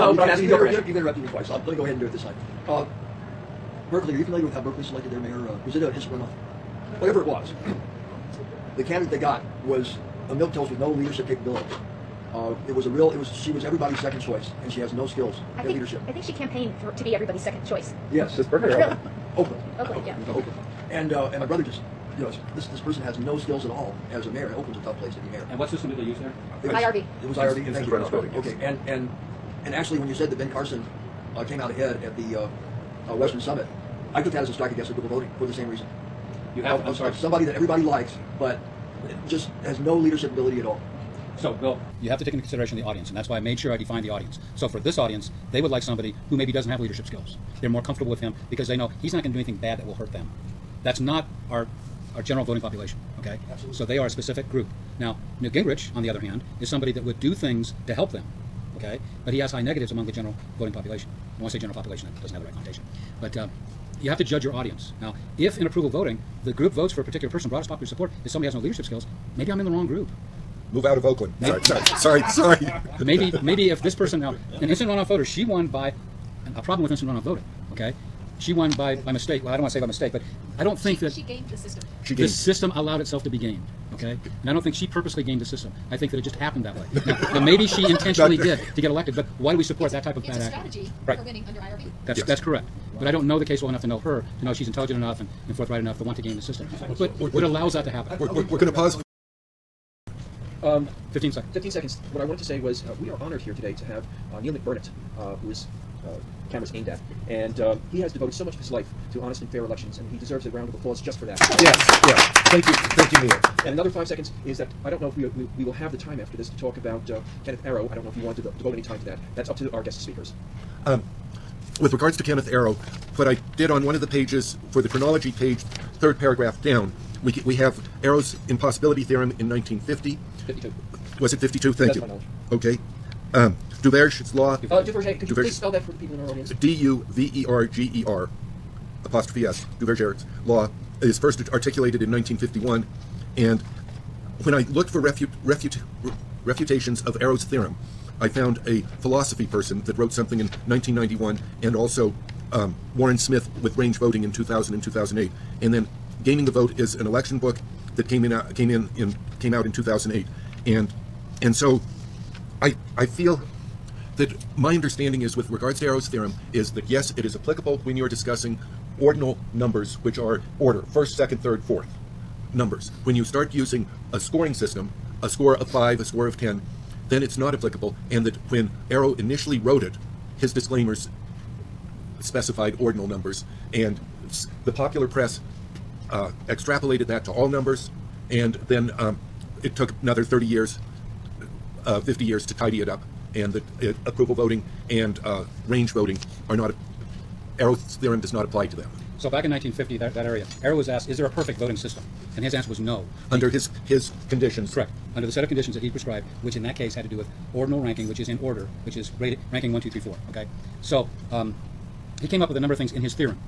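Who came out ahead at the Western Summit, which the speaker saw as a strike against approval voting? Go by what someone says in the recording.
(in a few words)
Ben Carson.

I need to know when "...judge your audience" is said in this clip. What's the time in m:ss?
1:04.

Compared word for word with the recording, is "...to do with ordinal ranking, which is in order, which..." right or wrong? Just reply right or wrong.
right.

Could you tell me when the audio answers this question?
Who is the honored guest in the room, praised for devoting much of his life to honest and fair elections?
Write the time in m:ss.
1:44.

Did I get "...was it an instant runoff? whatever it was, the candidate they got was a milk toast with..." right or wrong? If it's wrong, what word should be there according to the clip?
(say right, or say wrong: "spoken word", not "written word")
right.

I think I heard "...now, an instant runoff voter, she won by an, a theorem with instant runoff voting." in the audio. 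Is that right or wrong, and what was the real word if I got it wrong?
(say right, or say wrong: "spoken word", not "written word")
wrong: "problem", not "theorem".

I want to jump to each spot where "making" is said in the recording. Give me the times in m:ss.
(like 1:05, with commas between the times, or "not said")
not said.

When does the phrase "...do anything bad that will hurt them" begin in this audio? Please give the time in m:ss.
0:49.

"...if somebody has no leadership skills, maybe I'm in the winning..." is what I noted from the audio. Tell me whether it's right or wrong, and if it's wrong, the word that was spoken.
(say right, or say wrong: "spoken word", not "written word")
wrong: "wrong", not "winning".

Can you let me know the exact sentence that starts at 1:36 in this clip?
But it allows that to happen.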